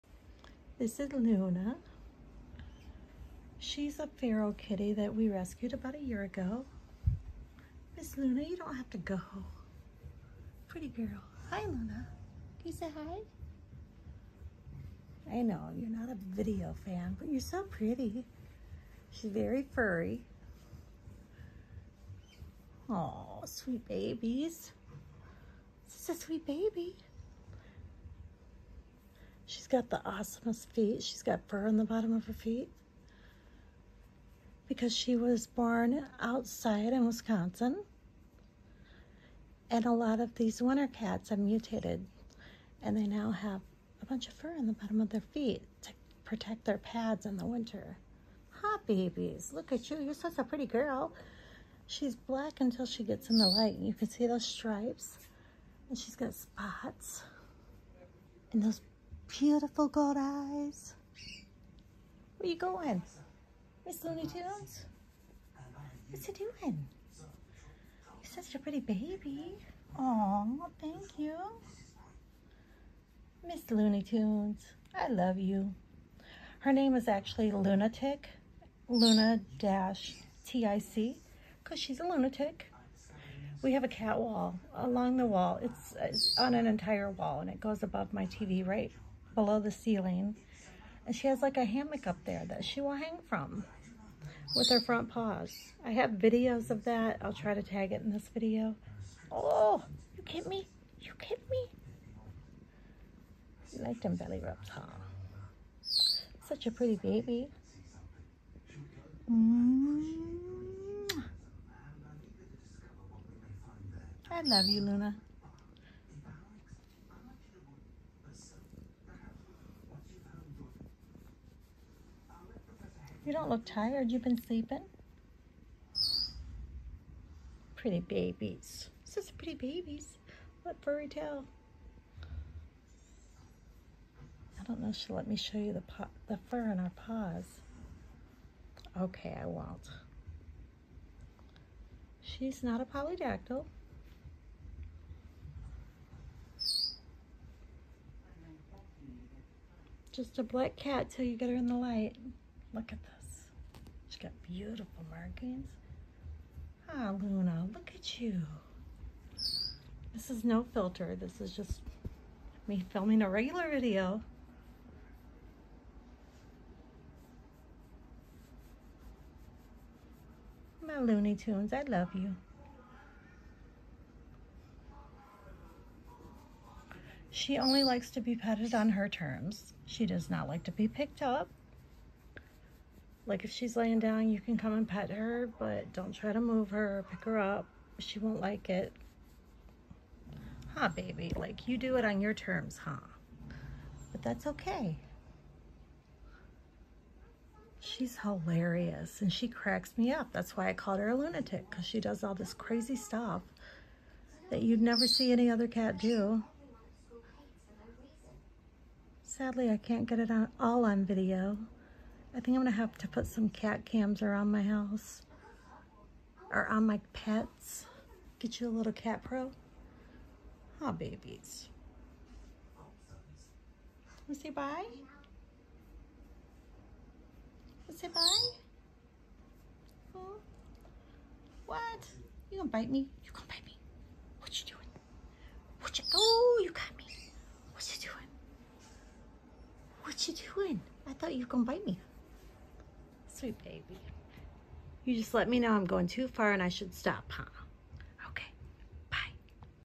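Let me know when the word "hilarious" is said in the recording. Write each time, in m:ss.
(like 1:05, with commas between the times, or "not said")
3:18.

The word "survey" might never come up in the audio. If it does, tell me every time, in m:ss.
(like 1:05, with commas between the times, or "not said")
not said.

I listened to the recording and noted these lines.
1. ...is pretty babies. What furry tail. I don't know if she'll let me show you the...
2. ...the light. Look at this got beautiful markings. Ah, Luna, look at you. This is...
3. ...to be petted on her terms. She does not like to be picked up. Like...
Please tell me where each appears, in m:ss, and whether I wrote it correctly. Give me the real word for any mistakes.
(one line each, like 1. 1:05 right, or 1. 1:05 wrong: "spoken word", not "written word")
1. 2:09 right
2. 2:31 right
3. 2:58 right.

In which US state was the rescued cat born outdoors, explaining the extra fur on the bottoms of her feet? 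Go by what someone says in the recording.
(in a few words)
Wisconsin.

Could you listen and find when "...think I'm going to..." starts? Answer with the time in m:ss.
3:32.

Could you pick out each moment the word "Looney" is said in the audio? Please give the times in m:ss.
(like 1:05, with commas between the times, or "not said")
1:04, 1:13, 2:50.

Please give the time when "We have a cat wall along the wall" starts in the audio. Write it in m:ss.
1:23.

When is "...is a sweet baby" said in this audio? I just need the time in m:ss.
0:26.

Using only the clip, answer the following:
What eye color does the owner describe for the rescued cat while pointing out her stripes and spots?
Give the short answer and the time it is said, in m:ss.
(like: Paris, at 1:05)
Gold, at 0:59.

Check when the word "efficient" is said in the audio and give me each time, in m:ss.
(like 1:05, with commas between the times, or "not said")
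not said.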